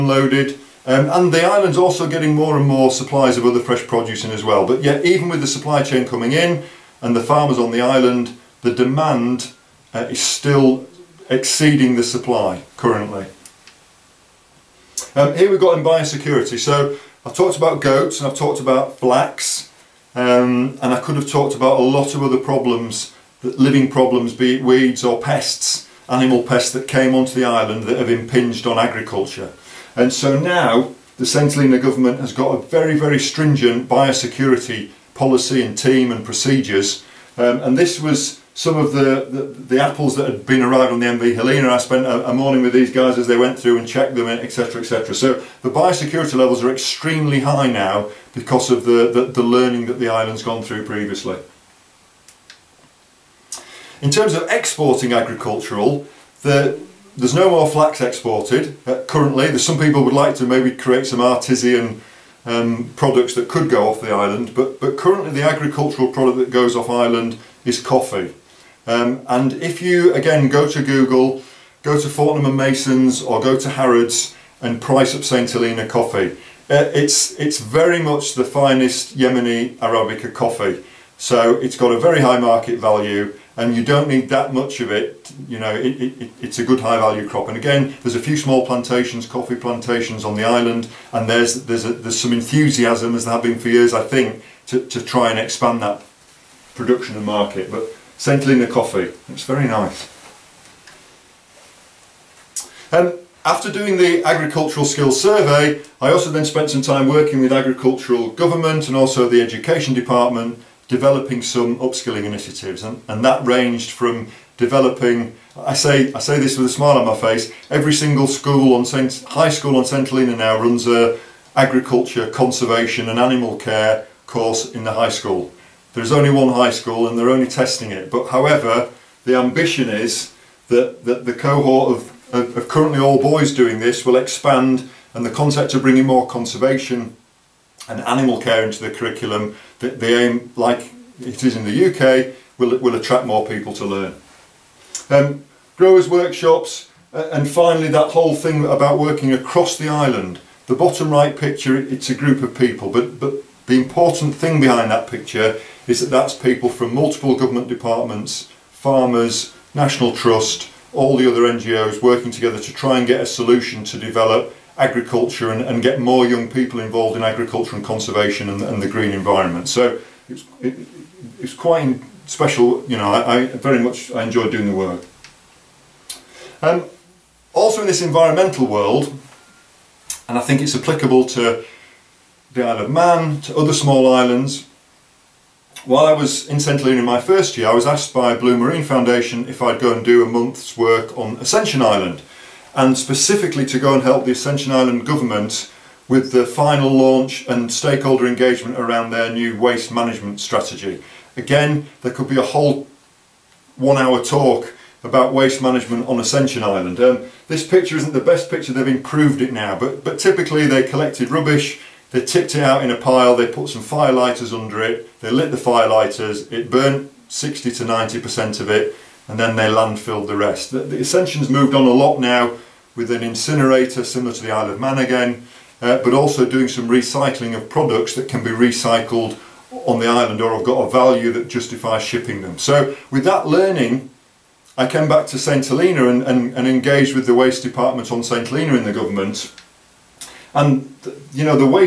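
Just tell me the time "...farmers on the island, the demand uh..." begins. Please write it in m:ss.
0:07.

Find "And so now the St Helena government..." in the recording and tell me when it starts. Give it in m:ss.
0:29.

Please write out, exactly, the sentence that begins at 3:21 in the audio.
Again, there could be a whole one hour talk about waste management on Ascension Island.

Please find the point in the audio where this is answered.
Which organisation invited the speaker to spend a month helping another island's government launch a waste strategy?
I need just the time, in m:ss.
3:08.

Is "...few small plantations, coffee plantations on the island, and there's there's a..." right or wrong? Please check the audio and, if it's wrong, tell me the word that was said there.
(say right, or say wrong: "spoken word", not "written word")
right.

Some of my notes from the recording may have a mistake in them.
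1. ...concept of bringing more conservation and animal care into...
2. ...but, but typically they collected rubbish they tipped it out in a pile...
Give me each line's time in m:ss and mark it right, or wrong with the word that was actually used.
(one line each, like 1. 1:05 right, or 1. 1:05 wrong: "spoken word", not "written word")
1. 2:15 right
2. 3:29 right.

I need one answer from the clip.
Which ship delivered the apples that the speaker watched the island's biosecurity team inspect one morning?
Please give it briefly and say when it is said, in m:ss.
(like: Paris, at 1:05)
MV Helena, at 0:41.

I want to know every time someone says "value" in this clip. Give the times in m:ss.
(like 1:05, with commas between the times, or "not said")
1:22, 1:26, 3:50.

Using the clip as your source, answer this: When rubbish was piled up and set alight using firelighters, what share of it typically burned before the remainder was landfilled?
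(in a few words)
60 to 90%.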